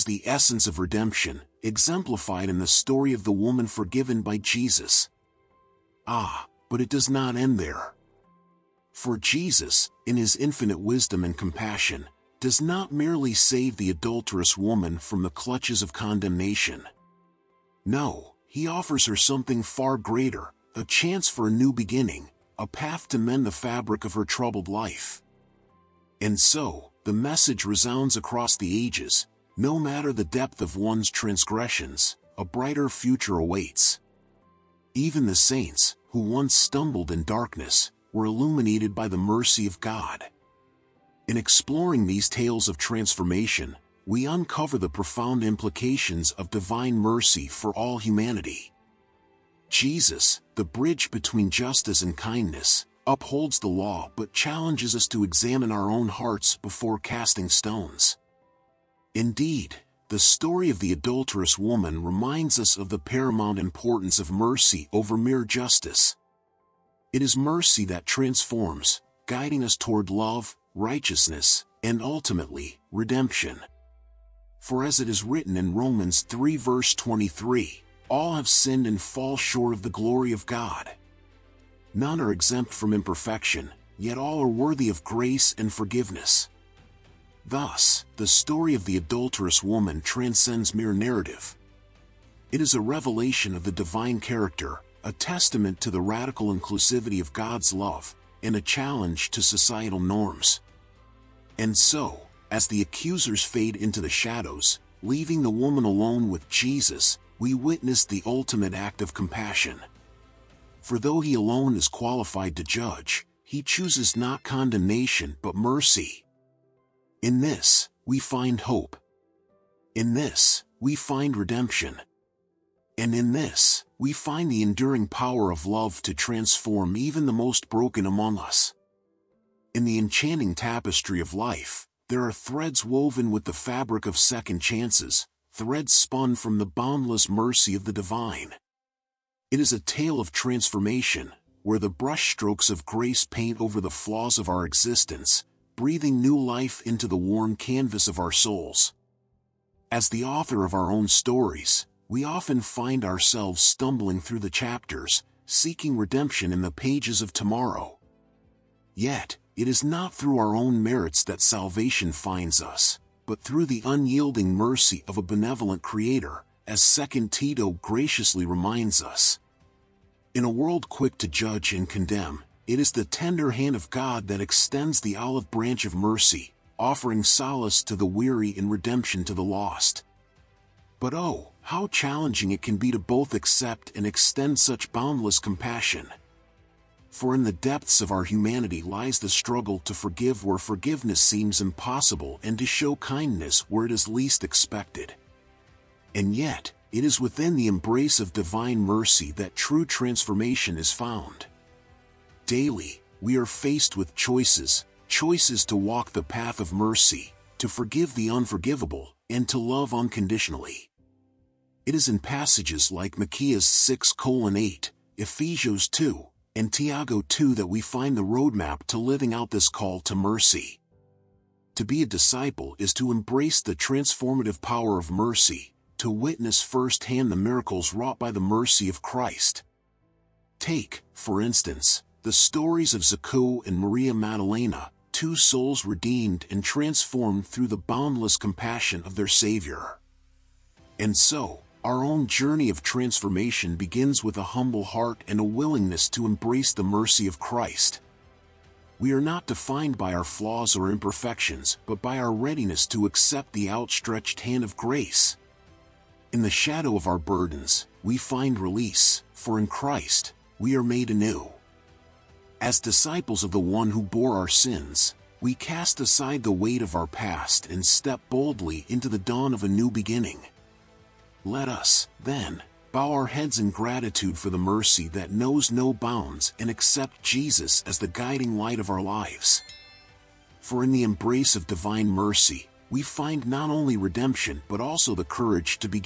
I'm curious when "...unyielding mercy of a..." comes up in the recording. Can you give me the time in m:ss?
2:43.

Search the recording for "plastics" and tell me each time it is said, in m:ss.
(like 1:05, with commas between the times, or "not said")
not said.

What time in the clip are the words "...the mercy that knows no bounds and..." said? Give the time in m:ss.
4:34.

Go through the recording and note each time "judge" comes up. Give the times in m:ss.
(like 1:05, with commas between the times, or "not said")
1:52, 2:51.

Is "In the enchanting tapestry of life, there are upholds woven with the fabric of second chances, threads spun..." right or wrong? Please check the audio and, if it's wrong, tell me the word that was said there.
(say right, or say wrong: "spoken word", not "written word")
wrong: "threads", not "upholds".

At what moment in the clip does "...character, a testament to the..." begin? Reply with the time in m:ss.
1:34.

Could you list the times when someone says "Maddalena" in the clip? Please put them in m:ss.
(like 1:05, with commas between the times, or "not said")
3:54.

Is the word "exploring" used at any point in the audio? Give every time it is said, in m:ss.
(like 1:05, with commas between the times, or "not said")
0:41.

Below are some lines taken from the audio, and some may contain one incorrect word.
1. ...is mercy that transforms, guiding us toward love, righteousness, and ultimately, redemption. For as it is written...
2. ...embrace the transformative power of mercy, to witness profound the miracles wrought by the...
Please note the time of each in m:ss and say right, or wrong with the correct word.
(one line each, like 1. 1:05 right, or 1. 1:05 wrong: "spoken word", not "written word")
1. 1:07 right
2. 3:43 wrong: "firsthand", not "profound".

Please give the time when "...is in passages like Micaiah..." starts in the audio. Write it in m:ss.
3:31.